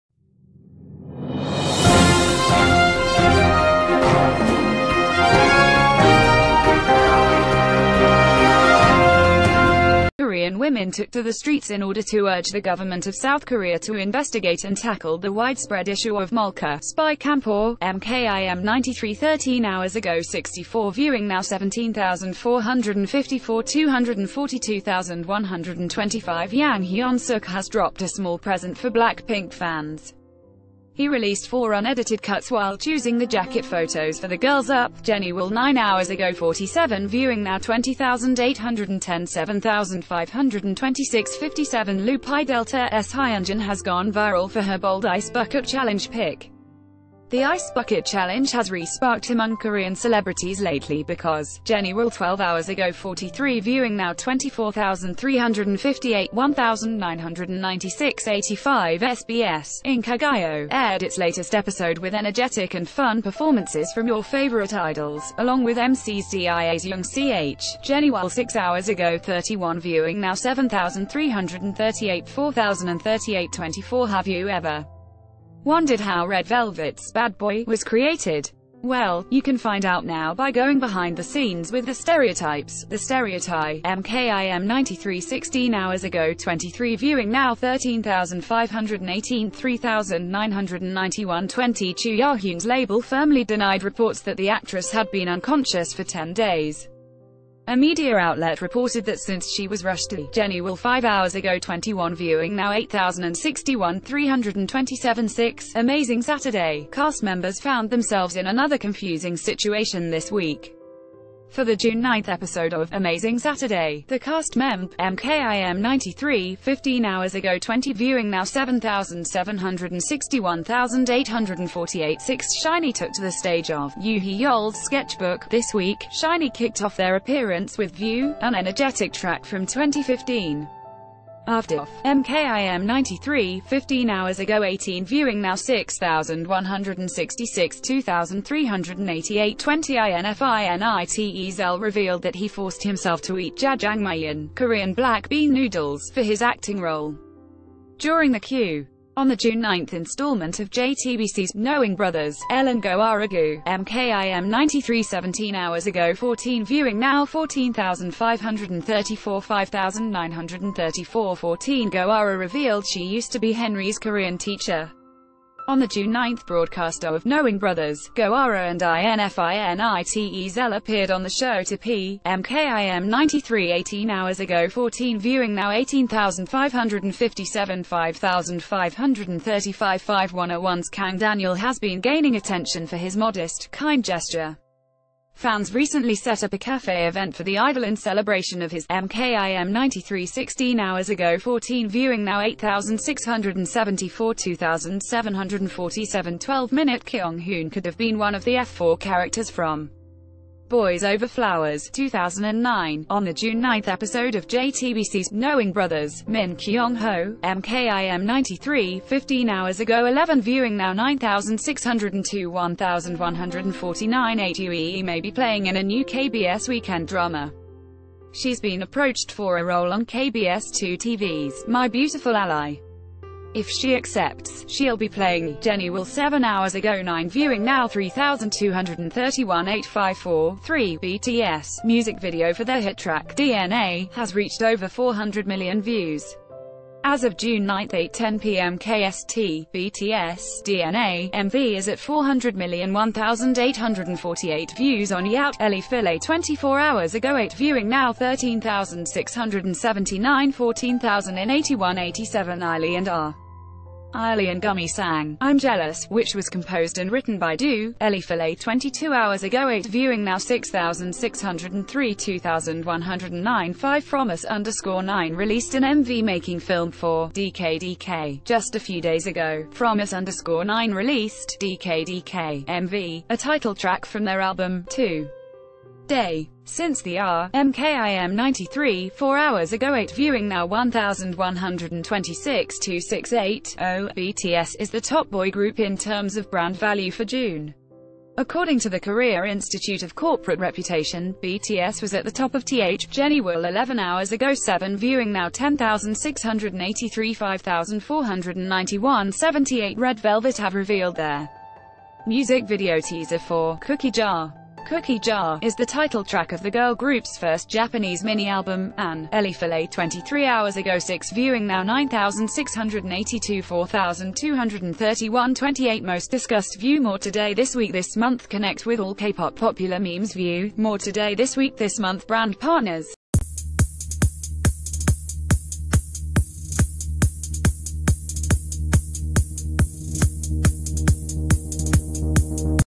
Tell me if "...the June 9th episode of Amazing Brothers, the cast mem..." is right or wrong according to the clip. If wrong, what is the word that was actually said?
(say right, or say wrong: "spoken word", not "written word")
wrong: "Saturday", not "Brothers".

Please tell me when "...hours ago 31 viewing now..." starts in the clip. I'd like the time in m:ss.
1:08.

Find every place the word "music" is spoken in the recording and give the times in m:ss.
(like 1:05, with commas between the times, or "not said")
3:51, 5:02.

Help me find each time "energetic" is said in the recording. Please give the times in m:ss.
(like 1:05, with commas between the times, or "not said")
1:02, 2:08.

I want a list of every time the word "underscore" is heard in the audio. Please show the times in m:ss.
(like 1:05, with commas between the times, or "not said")
4:24, 4:30.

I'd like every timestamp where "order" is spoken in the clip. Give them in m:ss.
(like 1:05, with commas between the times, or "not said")
0:11.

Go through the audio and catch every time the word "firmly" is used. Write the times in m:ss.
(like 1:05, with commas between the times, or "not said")
1:32.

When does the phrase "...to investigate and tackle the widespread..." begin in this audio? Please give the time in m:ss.
0:13.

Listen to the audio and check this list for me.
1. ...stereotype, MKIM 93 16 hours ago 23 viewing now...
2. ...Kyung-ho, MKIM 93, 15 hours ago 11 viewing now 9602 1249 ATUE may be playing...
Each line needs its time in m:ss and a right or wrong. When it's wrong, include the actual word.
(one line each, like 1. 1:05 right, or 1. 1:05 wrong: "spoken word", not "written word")
1. 1:22 right
2. 3:26 wrong: "1149", not "1249".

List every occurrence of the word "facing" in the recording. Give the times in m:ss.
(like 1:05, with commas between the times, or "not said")
not said.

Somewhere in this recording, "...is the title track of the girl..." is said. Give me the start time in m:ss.
5:05.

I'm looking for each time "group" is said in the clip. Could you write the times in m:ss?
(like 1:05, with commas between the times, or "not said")
4:45, 5:06.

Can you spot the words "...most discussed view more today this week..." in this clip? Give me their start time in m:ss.
5:16.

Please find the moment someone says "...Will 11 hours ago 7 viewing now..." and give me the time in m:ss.
4:53.